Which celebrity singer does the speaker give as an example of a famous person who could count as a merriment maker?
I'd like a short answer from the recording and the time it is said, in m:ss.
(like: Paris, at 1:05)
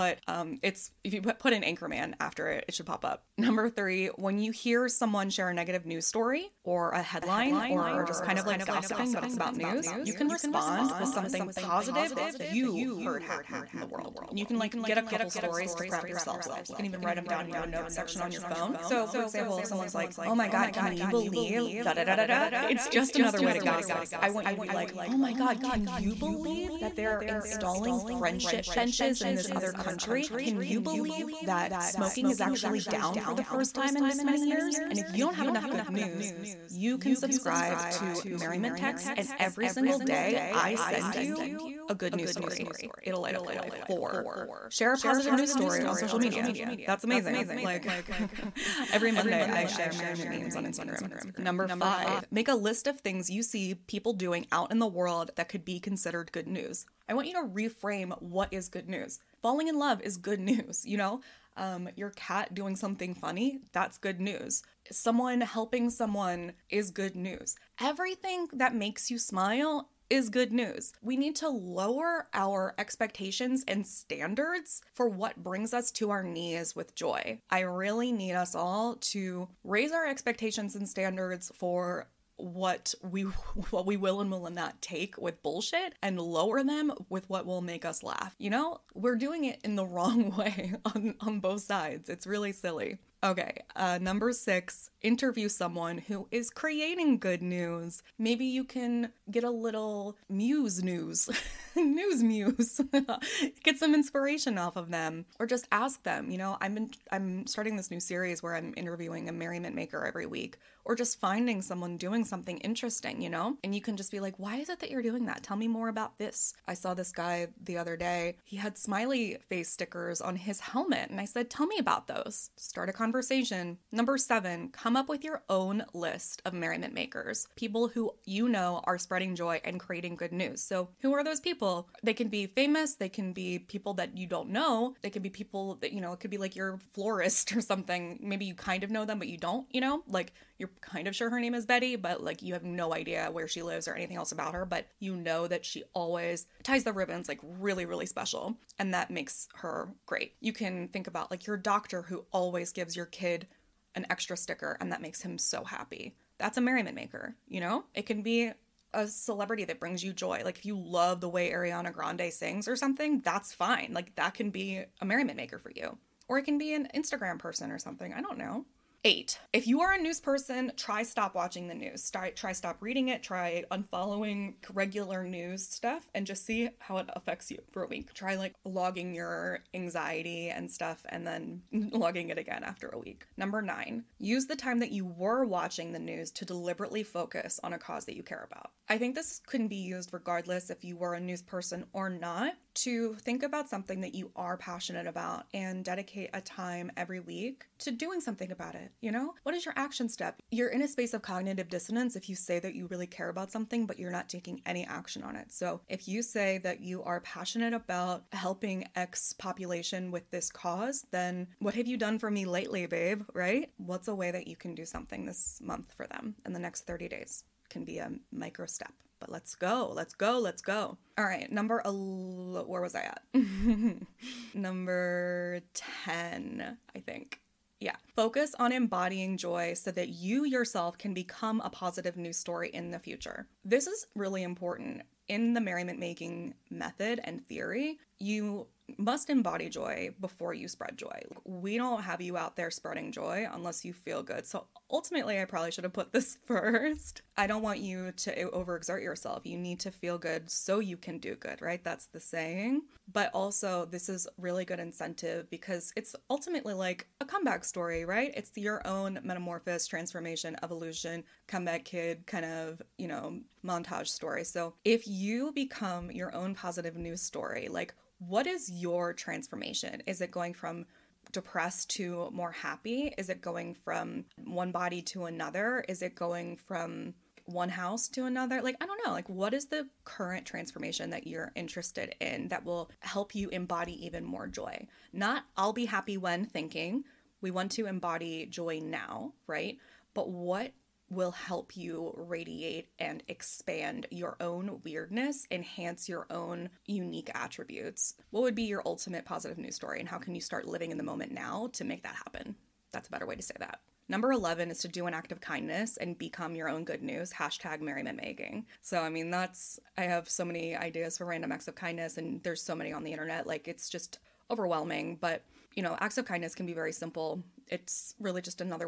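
Ariana Grande, at 2:41.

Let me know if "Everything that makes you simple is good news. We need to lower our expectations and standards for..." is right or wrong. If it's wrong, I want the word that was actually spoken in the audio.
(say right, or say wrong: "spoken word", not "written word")
wrong: "smile", not "simple".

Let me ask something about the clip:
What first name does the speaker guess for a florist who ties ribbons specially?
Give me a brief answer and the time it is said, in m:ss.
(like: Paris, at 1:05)
Betty, at 2:21.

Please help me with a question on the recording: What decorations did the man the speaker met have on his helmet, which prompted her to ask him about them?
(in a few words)
Smiley face stickers.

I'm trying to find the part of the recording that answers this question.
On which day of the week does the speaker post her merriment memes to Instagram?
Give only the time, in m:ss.
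0:49.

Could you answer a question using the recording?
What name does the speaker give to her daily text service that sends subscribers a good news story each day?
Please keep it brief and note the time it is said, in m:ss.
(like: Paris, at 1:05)
Merriment Text, at 0:38.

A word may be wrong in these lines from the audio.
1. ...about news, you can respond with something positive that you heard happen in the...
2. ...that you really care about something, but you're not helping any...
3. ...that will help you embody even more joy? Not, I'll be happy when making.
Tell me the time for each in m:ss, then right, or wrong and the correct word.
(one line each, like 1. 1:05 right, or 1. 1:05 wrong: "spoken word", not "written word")
1. 0:09 right
2. 3:22 wrong: "taking", not "helping"
3. 4:42 wrong: "thinking", not "making".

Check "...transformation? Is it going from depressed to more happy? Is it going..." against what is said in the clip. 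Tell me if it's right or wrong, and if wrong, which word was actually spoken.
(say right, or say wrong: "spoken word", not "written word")
right.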